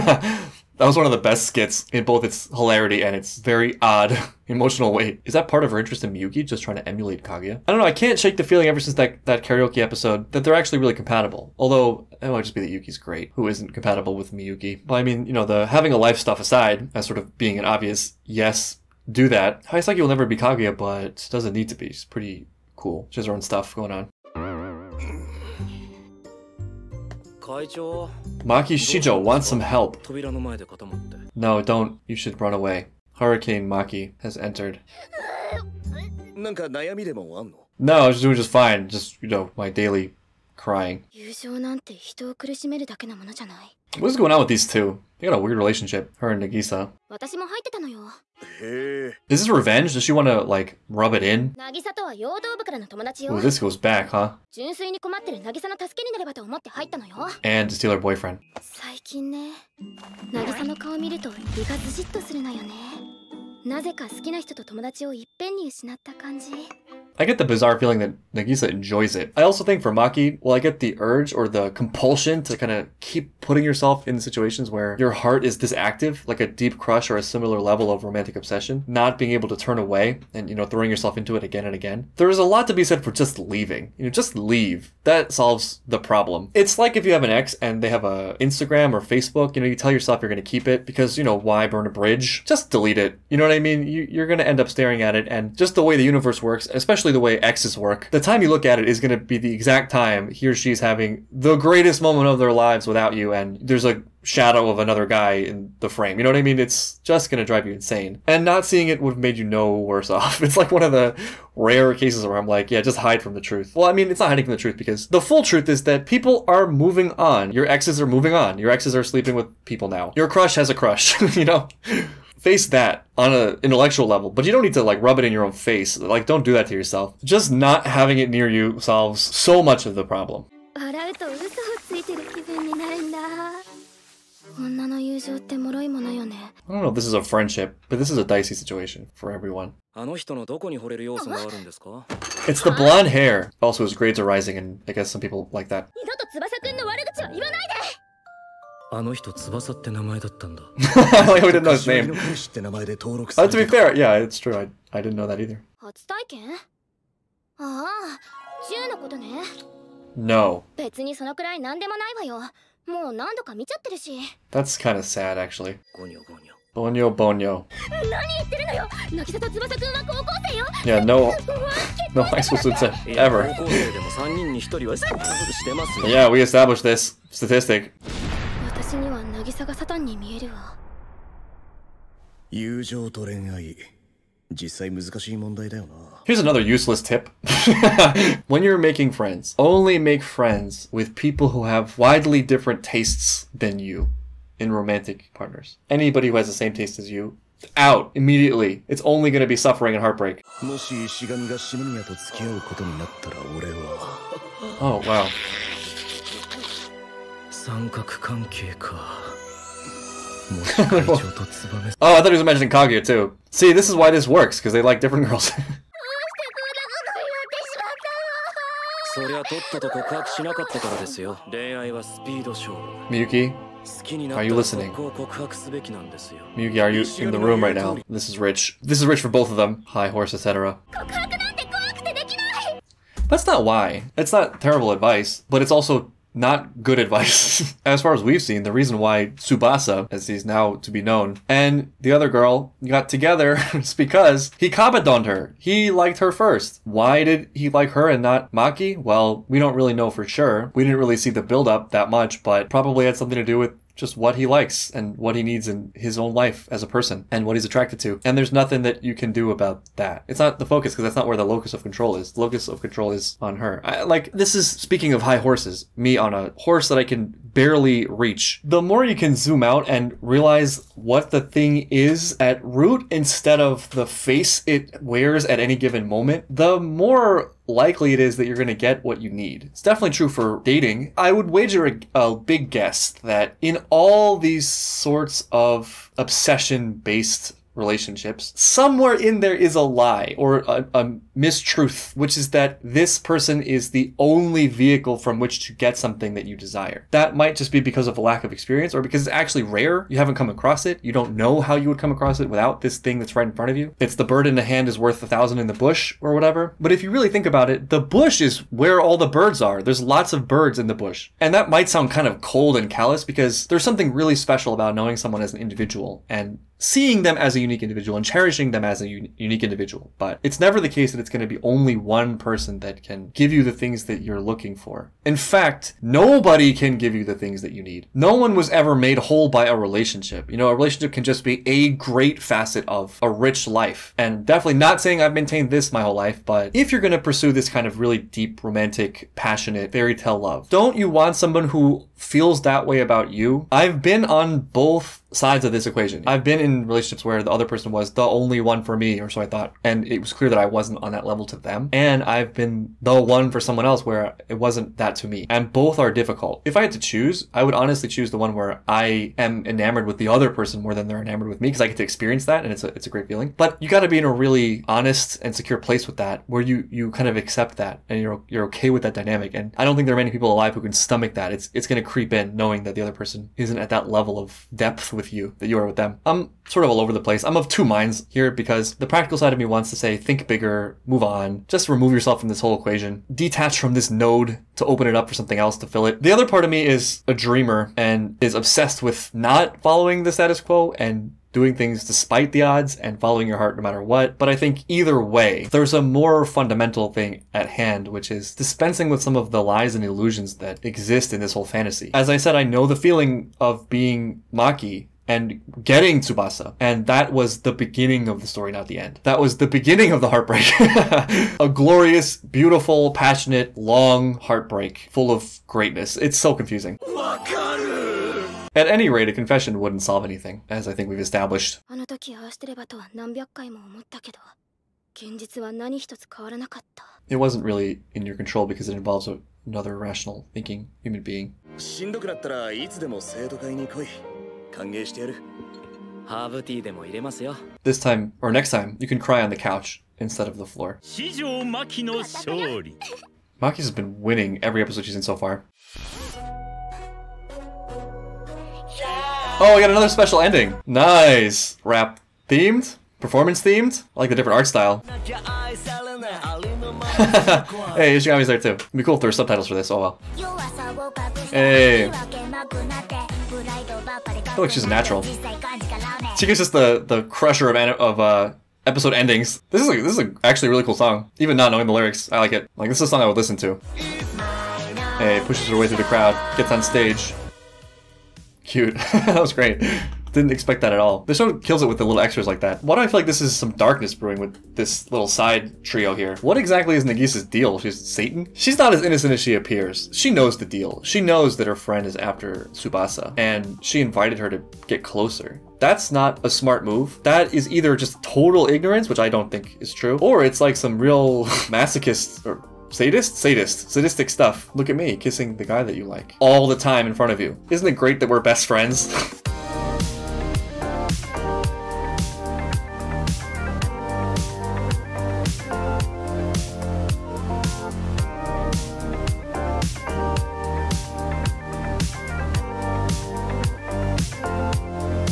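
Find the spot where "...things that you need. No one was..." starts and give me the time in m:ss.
5:27.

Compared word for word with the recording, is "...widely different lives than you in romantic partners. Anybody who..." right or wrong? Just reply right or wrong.
wrong.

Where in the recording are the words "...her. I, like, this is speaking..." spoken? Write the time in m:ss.
4:23.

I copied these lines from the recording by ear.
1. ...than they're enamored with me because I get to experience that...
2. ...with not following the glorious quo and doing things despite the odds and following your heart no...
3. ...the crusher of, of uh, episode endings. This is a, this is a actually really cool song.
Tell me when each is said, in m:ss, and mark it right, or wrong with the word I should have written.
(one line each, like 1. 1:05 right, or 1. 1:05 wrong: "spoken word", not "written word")
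1. 6:00 right
2. 6:29 wrong: "status", not "glorious"
3. 7:47 right.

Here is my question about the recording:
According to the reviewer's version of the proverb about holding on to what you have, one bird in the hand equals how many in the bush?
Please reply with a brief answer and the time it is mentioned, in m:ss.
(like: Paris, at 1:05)
1000, at 5:05.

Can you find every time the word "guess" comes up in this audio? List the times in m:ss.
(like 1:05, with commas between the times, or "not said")
2:24, 4:42.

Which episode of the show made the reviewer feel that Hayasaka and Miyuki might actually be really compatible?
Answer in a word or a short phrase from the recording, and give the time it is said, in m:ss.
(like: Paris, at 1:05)
Karaoke episode, at 0:09.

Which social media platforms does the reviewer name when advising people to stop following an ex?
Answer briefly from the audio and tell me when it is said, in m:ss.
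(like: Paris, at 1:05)
Instagram or Facebook, at 1:28.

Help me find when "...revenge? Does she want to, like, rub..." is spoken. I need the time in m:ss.
0:49.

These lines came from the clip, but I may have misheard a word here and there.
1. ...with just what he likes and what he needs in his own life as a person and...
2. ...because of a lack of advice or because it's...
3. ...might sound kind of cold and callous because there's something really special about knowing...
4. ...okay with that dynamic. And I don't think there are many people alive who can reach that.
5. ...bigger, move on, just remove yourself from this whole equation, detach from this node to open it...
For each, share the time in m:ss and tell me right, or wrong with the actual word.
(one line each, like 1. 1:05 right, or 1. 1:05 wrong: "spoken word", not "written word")
1. 4:13 right
2. 4:57 wrong: "experience", not "advice"
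3. 5:11 right
4. 6:08 wrong: "stomach", not "reach"
5. 6:20 right.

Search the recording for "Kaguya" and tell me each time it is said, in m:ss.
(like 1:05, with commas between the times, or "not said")
0:07, 0:20, 3:32.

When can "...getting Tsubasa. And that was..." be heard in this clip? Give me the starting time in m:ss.
6:45.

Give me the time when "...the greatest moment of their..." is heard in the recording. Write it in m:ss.
1:41.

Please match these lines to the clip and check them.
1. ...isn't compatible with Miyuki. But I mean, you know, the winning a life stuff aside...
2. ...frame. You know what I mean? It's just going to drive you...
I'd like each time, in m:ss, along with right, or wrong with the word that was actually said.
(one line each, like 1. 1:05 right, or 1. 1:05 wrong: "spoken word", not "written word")
1. 0:13 wrong: "having", not "winning"
2. 1:45 right.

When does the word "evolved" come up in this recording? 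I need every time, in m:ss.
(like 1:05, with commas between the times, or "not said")
not said.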